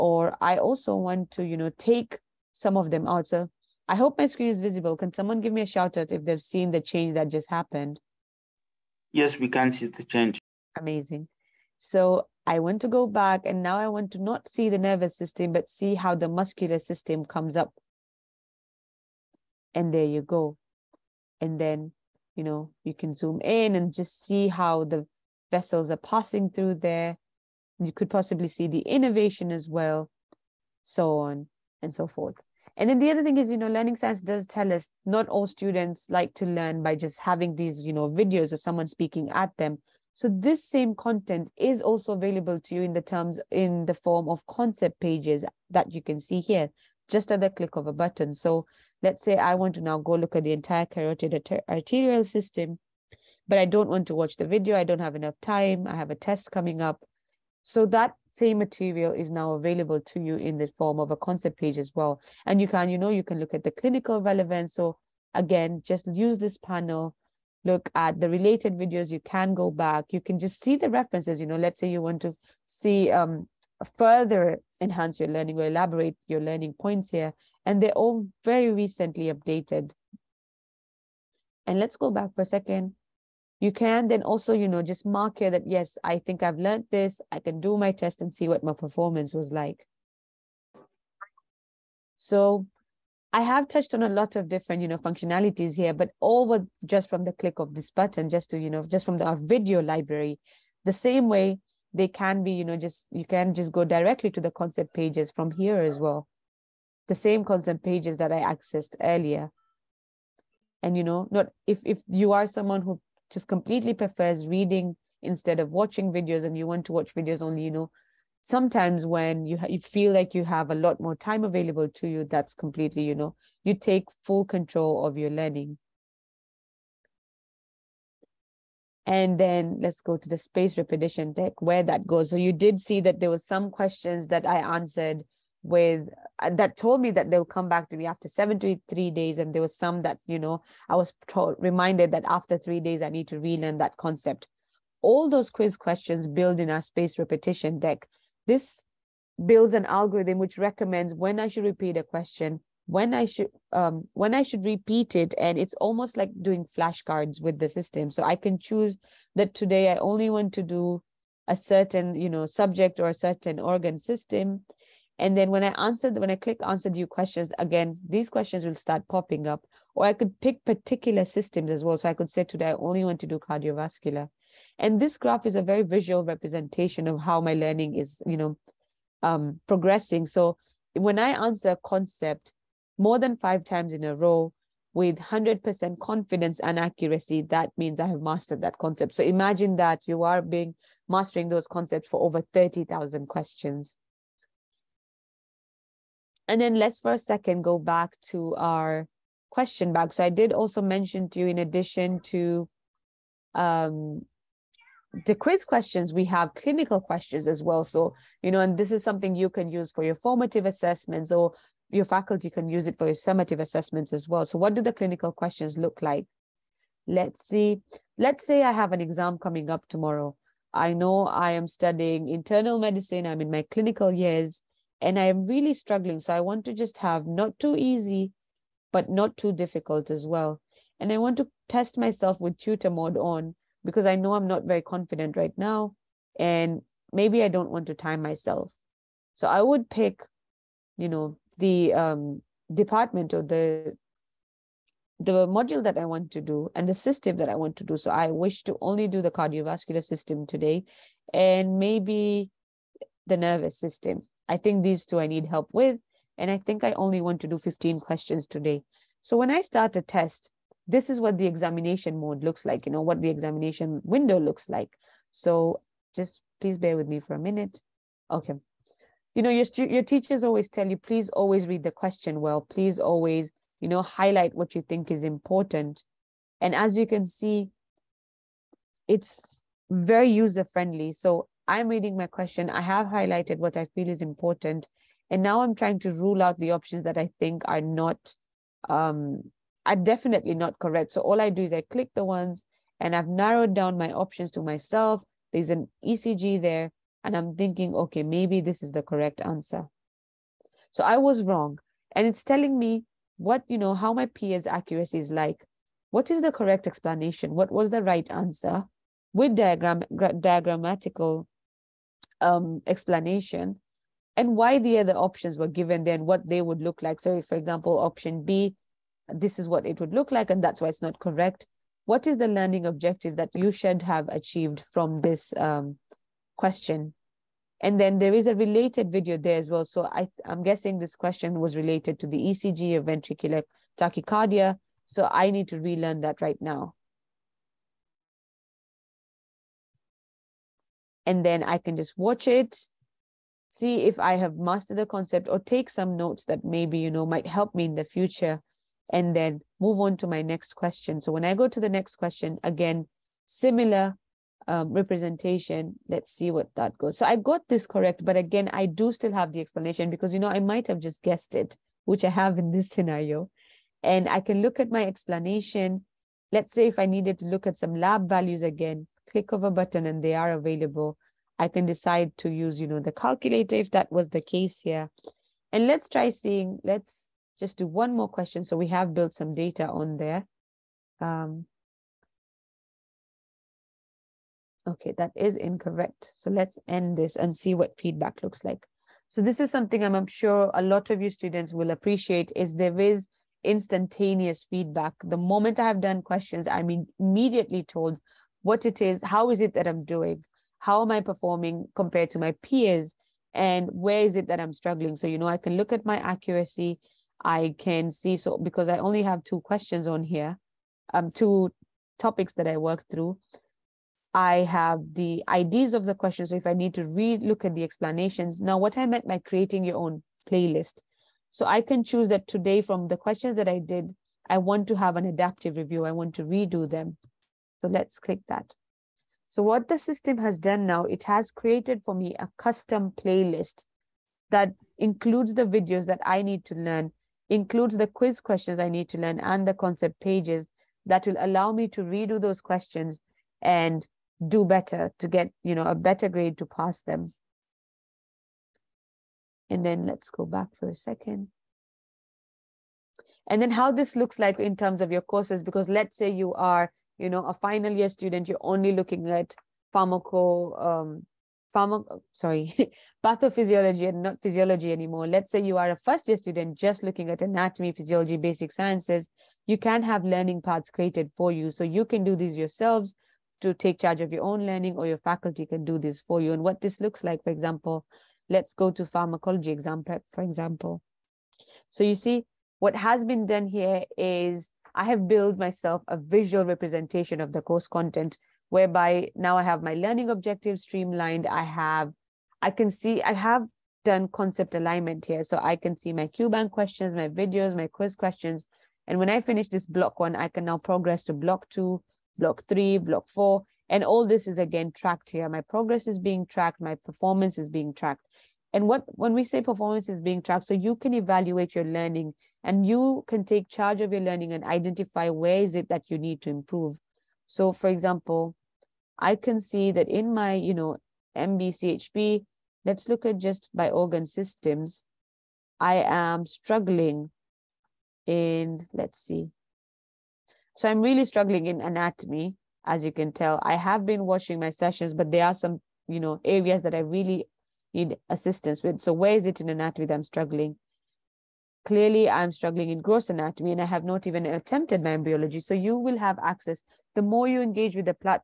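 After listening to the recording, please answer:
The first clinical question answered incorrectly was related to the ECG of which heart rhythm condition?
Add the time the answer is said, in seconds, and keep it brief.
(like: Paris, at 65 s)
ventricular tachycardia, at 333 s.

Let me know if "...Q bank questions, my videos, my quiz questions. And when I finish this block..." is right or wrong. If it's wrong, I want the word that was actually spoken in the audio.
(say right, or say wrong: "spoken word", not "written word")
right.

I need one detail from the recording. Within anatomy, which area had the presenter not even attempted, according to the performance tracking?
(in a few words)
embryology.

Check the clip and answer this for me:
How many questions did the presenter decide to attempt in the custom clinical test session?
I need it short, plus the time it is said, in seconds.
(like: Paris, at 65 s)
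15, at 257 s.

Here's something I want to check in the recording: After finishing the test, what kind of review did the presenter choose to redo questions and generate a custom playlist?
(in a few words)
adaptive review.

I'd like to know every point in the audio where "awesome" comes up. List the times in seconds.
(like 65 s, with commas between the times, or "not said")
not said.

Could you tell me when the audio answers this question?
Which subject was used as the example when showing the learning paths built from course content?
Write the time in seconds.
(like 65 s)
479 s.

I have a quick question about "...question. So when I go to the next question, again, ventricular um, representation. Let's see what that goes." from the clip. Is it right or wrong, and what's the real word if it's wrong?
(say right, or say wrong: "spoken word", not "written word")
wrong: "similar", not "ventricular".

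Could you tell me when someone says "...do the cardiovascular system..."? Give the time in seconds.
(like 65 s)
249 s.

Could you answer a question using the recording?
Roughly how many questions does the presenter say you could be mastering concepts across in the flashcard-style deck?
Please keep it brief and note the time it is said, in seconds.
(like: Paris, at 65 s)
30,000, at 192 s.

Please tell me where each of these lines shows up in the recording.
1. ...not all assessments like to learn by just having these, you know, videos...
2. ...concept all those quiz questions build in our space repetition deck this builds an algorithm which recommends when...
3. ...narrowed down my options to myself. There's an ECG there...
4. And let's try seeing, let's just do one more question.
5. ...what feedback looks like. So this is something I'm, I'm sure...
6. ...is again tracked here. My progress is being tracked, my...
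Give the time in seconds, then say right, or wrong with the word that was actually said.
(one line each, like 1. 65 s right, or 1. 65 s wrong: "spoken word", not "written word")
1. 35 s wrong: "students", not "assessments"
2. 143 s right
3. 293 s right
4. 375 s right
5. 387 s right
6. 504 s right.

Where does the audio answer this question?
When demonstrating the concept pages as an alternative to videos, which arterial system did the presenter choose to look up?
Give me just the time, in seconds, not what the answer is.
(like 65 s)
50 s.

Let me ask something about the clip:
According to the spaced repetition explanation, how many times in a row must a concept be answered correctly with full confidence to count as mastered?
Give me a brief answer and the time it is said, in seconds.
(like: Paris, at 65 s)
5, at 183 s.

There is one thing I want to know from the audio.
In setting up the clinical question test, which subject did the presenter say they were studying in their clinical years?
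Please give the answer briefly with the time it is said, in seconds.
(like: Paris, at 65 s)
internal medicine, at 222 s.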